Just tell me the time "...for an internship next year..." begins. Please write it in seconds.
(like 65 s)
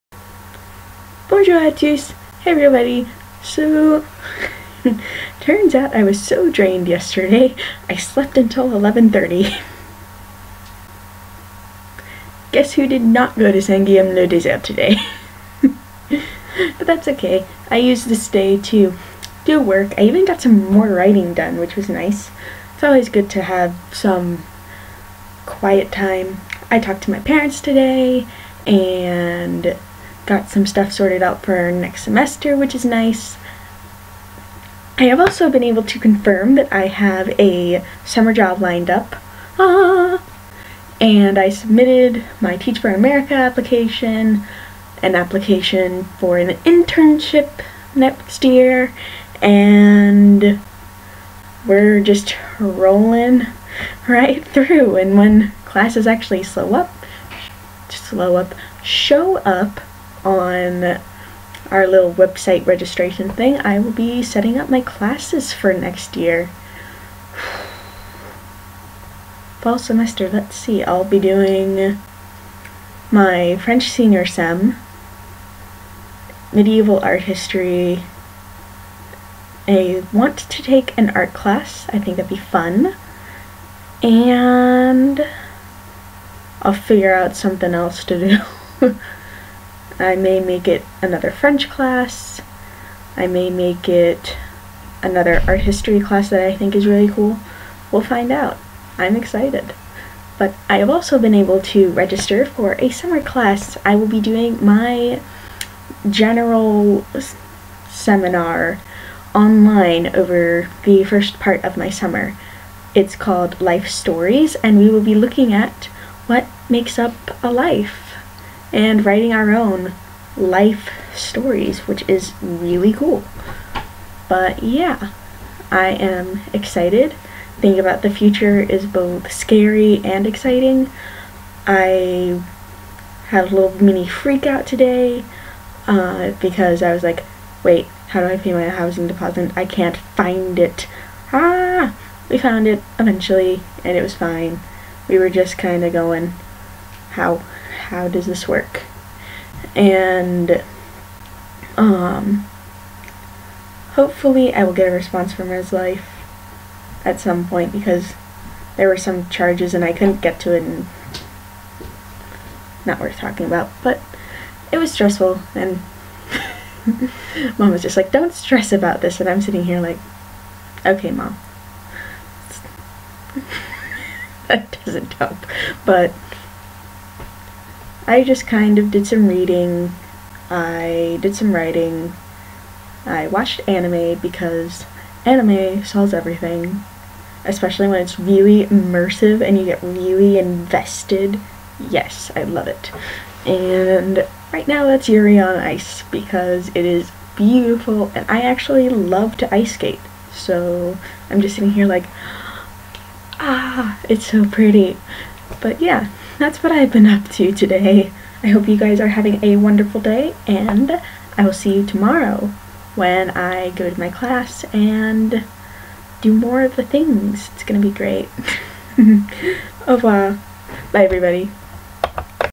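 46 s.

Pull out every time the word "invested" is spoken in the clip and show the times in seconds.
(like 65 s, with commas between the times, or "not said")
190 s.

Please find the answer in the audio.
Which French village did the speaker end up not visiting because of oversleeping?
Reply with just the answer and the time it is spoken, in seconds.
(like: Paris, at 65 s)
Saint-Guilhem-le-Désert, at 13 s.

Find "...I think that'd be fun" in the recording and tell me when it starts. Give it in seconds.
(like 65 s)
81 s.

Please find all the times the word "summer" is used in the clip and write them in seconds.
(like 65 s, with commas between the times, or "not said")
38 s, 102 s, 111 s.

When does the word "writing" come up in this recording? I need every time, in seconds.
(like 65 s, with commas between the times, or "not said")
20 s, 119 s, 181 s.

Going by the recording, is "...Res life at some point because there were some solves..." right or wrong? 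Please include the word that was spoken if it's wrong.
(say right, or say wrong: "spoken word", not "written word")
wrong: "charges", not "solves".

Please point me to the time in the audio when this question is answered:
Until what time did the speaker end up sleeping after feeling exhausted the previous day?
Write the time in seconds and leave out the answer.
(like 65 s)
8 s.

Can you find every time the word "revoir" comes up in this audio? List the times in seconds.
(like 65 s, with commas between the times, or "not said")
219 s.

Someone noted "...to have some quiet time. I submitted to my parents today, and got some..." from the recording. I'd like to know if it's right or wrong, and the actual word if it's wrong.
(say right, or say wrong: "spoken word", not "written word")
wrong: "talked", not "submitted".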